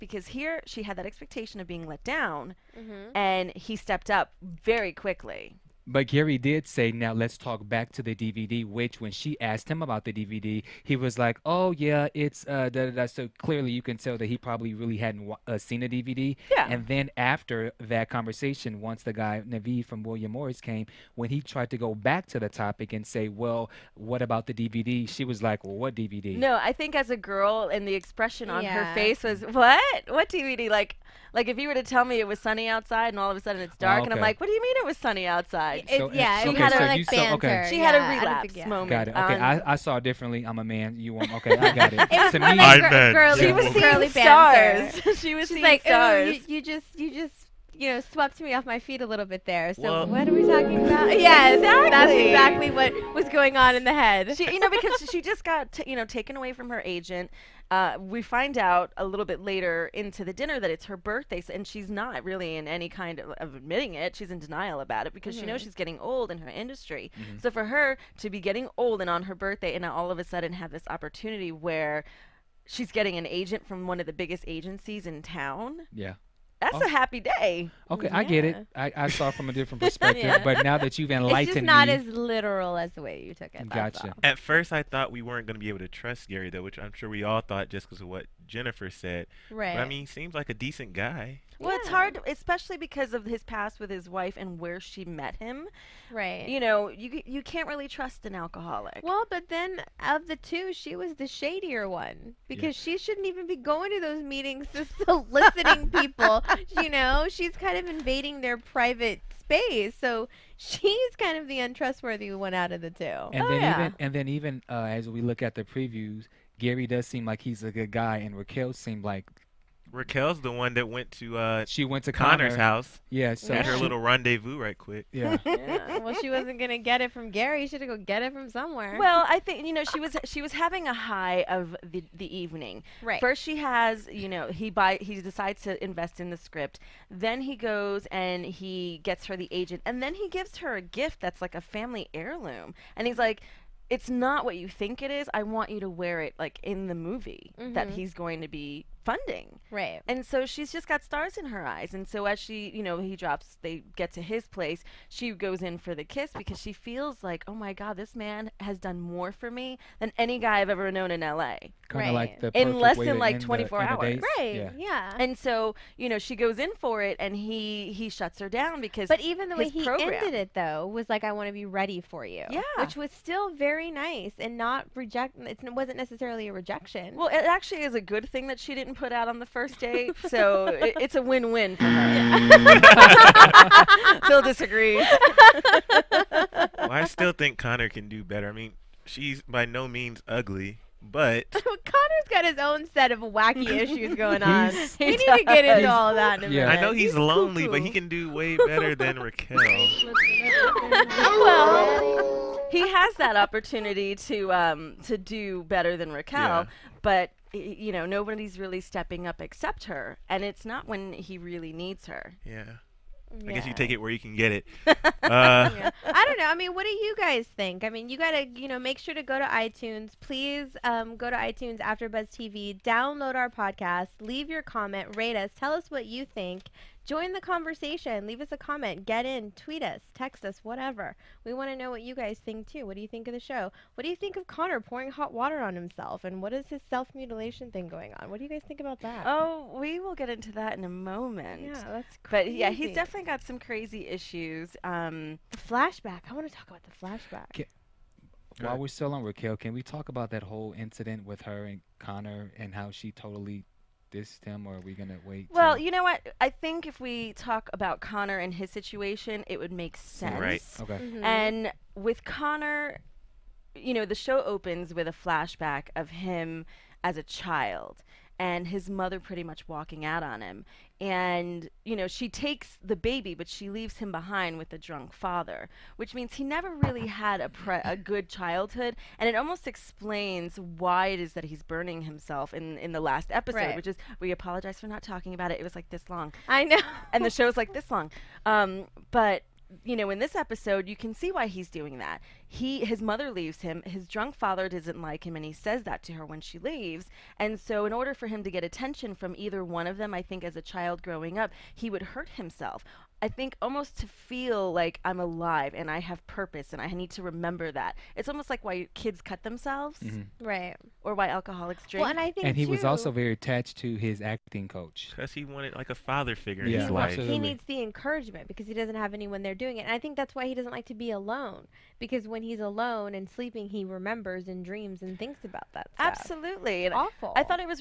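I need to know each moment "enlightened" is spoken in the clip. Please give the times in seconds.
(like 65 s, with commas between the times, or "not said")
81 s.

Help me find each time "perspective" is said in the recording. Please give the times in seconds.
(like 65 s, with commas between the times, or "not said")
79 s.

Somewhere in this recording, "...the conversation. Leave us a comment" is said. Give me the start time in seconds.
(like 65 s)
227 s.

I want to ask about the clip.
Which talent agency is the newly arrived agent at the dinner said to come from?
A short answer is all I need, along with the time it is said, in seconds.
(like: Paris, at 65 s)
William Morris, at 20 s.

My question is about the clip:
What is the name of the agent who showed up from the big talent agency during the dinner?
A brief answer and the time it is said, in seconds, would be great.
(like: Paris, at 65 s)
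Naveed, at 19 s.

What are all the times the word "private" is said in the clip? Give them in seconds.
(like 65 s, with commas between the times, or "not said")
108 s.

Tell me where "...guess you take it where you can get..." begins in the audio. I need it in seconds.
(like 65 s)
213 s.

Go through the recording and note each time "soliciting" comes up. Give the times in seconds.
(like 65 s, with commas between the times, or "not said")
105 s.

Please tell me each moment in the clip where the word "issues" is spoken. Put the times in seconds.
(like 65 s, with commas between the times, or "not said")
193 s, 244 s.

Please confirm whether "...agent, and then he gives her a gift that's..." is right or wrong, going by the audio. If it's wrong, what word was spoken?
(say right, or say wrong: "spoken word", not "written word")
right.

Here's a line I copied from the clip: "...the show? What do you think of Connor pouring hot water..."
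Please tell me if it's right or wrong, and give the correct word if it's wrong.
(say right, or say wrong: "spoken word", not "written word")
right.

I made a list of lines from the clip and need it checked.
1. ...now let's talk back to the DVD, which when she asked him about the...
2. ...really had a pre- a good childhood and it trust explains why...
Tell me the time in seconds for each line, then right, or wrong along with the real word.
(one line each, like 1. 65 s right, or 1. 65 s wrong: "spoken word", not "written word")
1. 6 s right
2. 276 s wrong: "almost", not "trust".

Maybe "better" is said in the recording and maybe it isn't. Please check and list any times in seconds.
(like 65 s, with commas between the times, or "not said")
188 s, 198 s, 205 s.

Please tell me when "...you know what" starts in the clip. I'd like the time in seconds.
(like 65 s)
255 s.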